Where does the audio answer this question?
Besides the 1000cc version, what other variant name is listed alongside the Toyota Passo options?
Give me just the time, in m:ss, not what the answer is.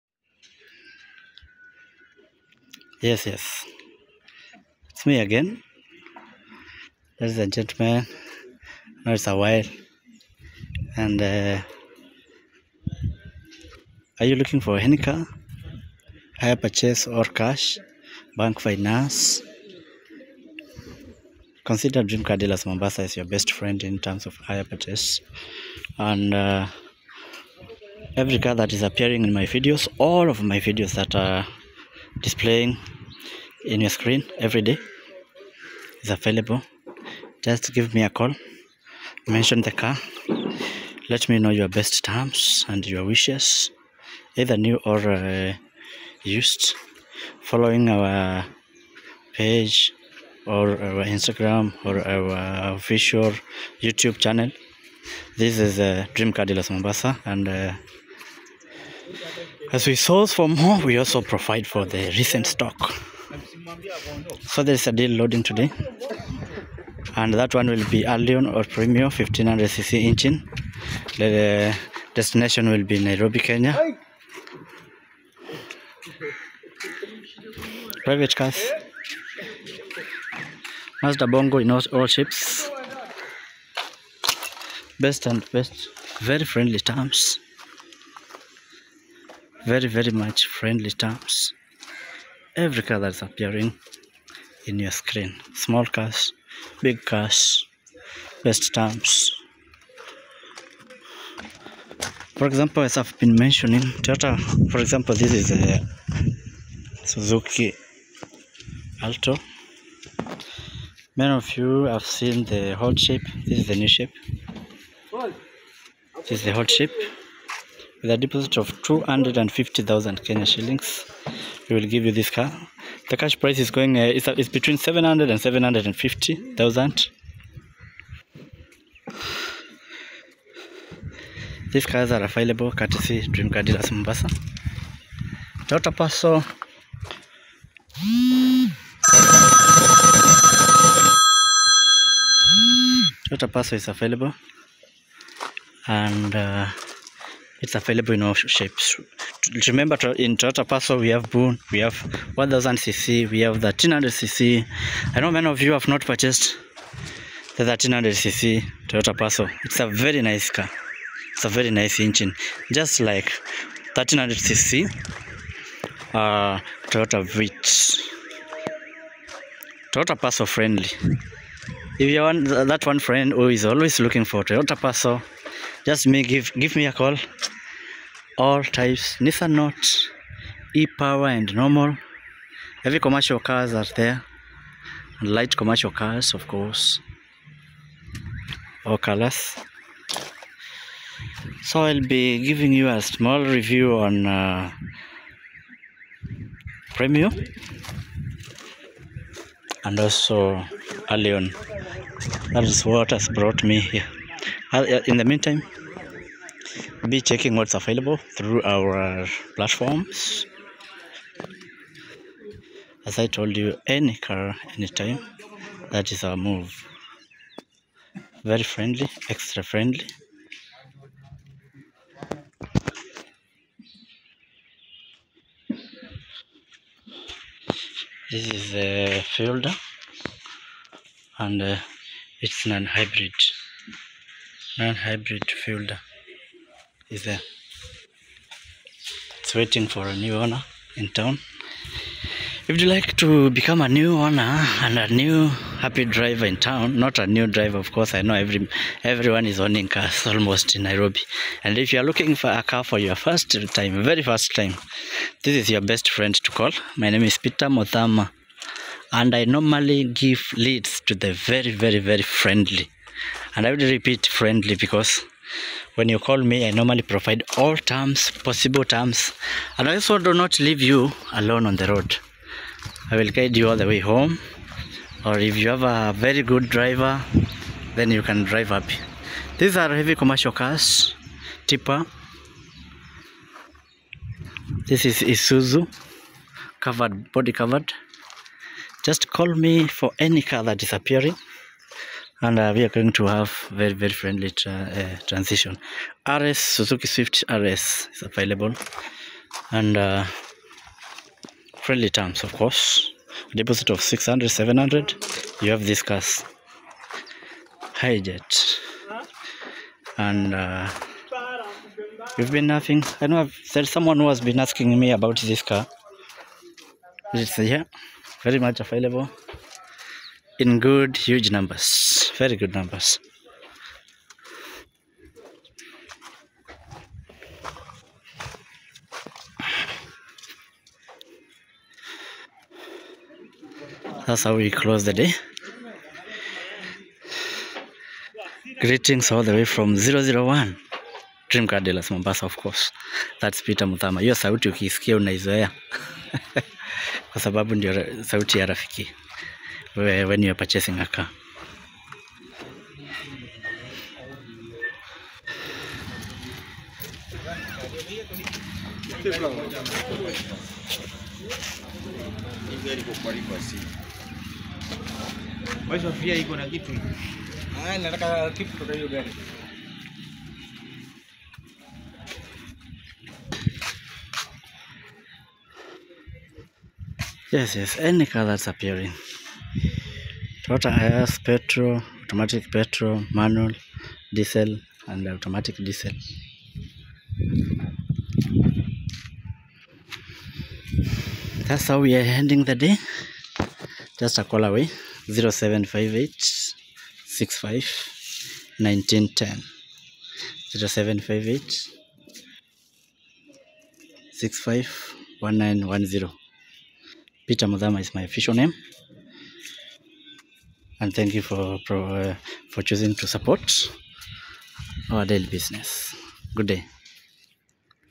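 2:31.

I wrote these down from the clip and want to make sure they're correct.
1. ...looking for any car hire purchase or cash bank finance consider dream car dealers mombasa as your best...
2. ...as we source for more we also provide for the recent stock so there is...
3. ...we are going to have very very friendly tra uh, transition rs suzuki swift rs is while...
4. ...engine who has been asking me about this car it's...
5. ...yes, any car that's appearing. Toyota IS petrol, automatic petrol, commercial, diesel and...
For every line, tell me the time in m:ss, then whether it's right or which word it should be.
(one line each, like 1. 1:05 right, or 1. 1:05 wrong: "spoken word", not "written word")
1. 0:14 right
2. 0:59 right
3. 4:52 wrong: "available", not "while"
4. 5:13 wrong: "someone", not "engine"
5. 6:17 wrong: "manual", not "commercial".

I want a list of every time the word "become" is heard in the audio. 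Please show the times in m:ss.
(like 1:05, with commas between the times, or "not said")
4:03.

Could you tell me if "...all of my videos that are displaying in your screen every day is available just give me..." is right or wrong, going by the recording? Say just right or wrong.
right.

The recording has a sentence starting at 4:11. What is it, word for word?
And if you are looking for a car for your first time, very first time, this is your best friend to call.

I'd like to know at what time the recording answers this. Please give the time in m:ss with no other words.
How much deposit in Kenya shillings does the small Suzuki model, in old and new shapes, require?
1:58.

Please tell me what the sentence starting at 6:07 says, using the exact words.
Ah, nataka kitu kutoka hiyo gari.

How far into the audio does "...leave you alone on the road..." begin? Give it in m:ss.
4:30.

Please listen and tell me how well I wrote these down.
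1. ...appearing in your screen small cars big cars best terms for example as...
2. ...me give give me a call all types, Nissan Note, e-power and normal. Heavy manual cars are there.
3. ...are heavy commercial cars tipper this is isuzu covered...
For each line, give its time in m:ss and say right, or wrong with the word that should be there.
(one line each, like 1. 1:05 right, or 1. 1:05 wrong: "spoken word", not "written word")
1. 1:33 right
2. 2:56 wrong: "commercial", not "manual"
3. 4:39 right.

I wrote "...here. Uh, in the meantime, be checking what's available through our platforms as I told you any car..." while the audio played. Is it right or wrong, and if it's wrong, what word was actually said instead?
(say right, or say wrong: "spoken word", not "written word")
right.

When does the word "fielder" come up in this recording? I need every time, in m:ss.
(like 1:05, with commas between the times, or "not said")
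3:49, 3:55.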